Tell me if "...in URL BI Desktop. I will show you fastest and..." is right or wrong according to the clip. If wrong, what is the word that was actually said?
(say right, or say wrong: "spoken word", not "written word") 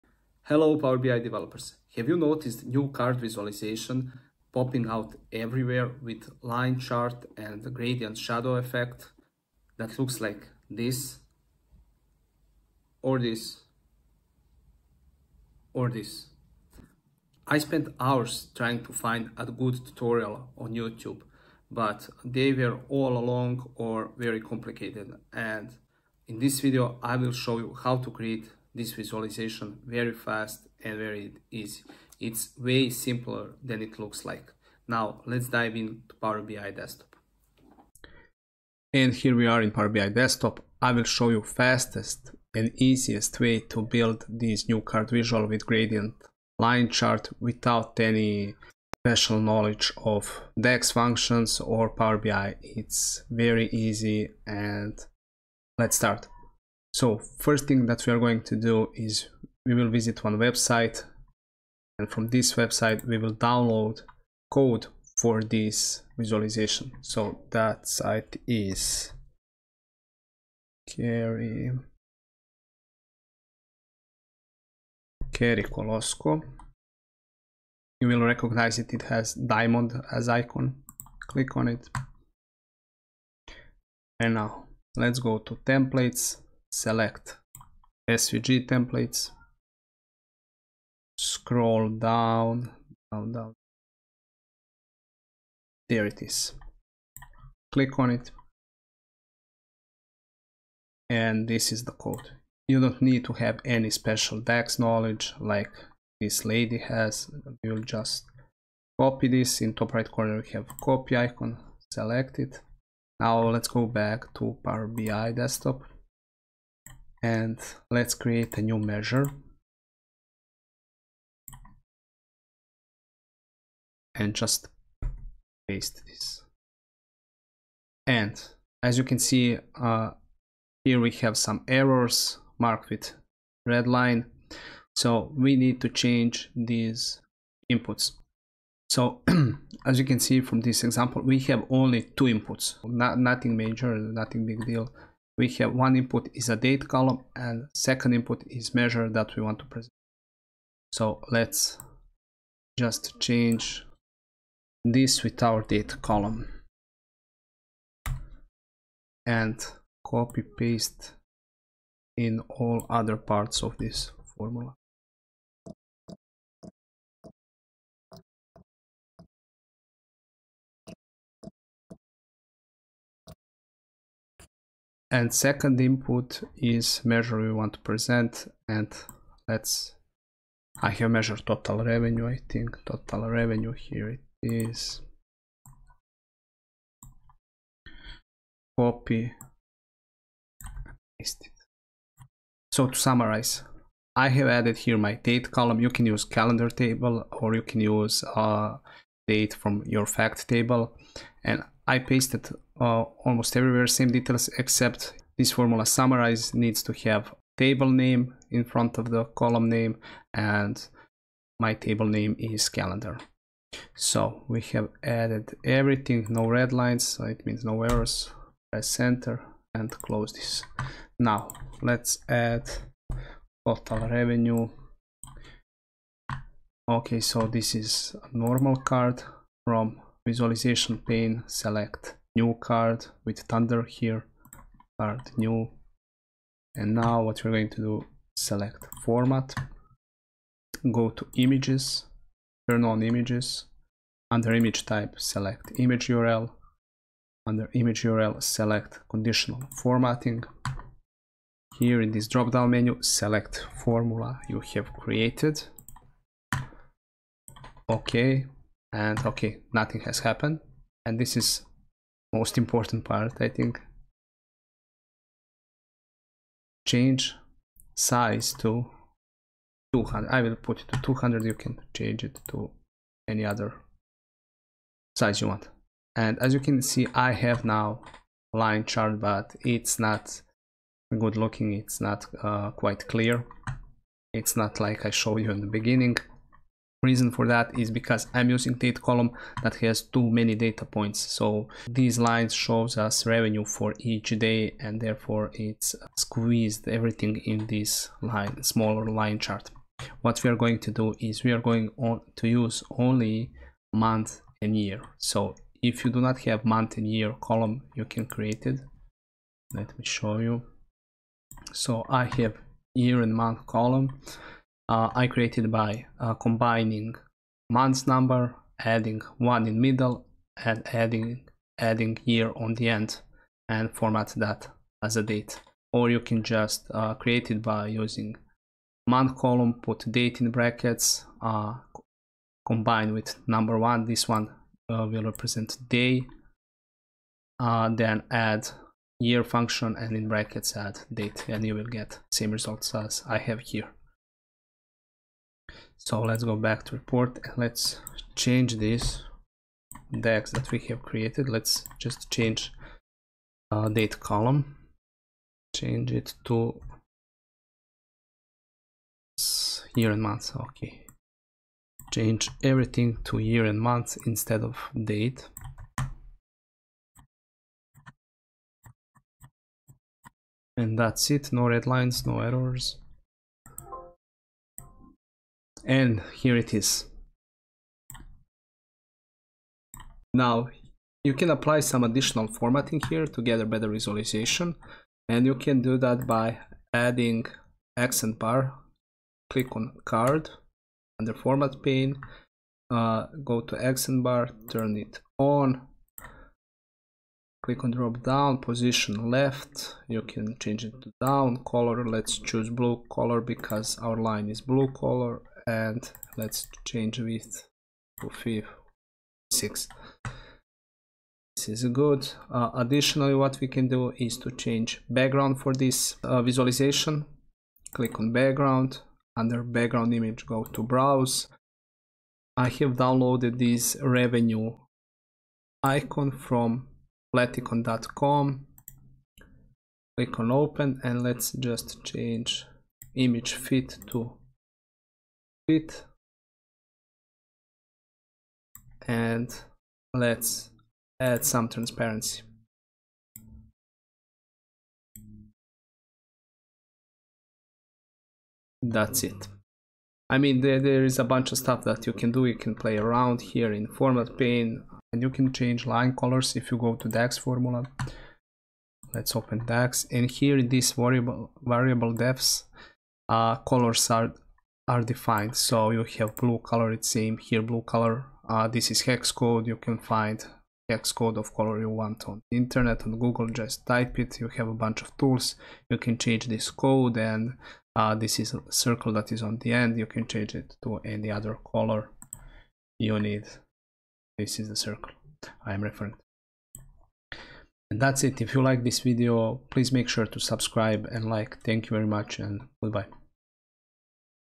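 wrong: "Power", not "URL".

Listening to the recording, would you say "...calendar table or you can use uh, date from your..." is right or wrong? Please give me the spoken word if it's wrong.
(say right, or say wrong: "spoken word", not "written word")
right.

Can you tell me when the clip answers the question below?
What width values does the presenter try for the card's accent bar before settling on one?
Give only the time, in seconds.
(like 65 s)
408 s.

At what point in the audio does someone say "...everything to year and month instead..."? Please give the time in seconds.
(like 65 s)
362 s.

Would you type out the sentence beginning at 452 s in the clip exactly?
You can play around here in format pane and you can change line colors if you go to DAX formula.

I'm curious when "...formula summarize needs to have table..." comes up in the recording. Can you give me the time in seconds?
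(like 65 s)
205 s.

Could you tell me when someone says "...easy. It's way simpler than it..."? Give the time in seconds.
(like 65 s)
31 s.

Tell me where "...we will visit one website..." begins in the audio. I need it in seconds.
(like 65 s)
59 s.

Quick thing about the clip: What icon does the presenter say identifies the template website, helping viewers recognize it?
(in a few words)
diamond.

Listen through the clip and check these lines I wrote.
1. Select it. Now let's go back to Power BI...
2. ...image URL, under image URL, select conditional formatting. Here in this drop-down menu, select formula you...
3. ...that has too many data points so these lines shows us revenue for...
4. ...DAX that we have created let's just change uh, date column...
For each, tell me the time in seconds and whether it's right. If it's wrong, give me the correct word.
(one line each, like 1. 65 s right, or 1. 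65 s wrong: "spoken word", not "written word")
1. 111 s right
2. 245 s right
3. 289 s right
4. 350 s right.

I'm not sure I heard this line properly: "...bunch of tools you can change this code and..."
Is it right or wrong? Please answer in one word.
right.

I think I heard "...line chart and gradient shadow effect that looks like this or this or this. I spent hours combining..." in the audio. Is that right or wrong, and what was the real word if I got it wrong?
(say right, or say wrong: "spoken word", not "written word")
wrong: "trying", not "combining".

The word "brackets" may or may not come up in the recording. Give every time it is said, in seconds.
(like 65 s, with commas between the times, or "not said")
330 s, 340 s.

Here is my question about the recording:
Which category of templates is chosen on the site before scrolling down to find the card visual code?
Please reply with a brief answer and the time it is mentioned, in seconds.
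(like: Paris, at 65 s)
SVG templates, at 88 s.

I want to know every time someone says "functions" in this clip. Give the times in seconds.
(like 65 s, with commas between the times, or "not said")
50 s, 339 s.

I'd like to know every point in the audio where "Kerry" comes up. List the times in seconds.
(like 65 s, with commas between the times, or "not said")
70 s, 75 s.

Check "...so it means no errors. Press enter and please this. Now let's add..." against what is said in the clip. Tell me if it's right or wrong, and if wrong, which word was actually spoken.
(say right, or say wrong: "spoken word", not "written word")
wrong: "close", not "please".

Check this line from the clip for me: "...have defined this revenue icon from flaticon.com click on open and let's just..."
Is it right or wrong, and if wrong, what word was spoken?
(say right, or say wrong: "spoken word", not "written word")
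wrong: "downloaded", not "defined".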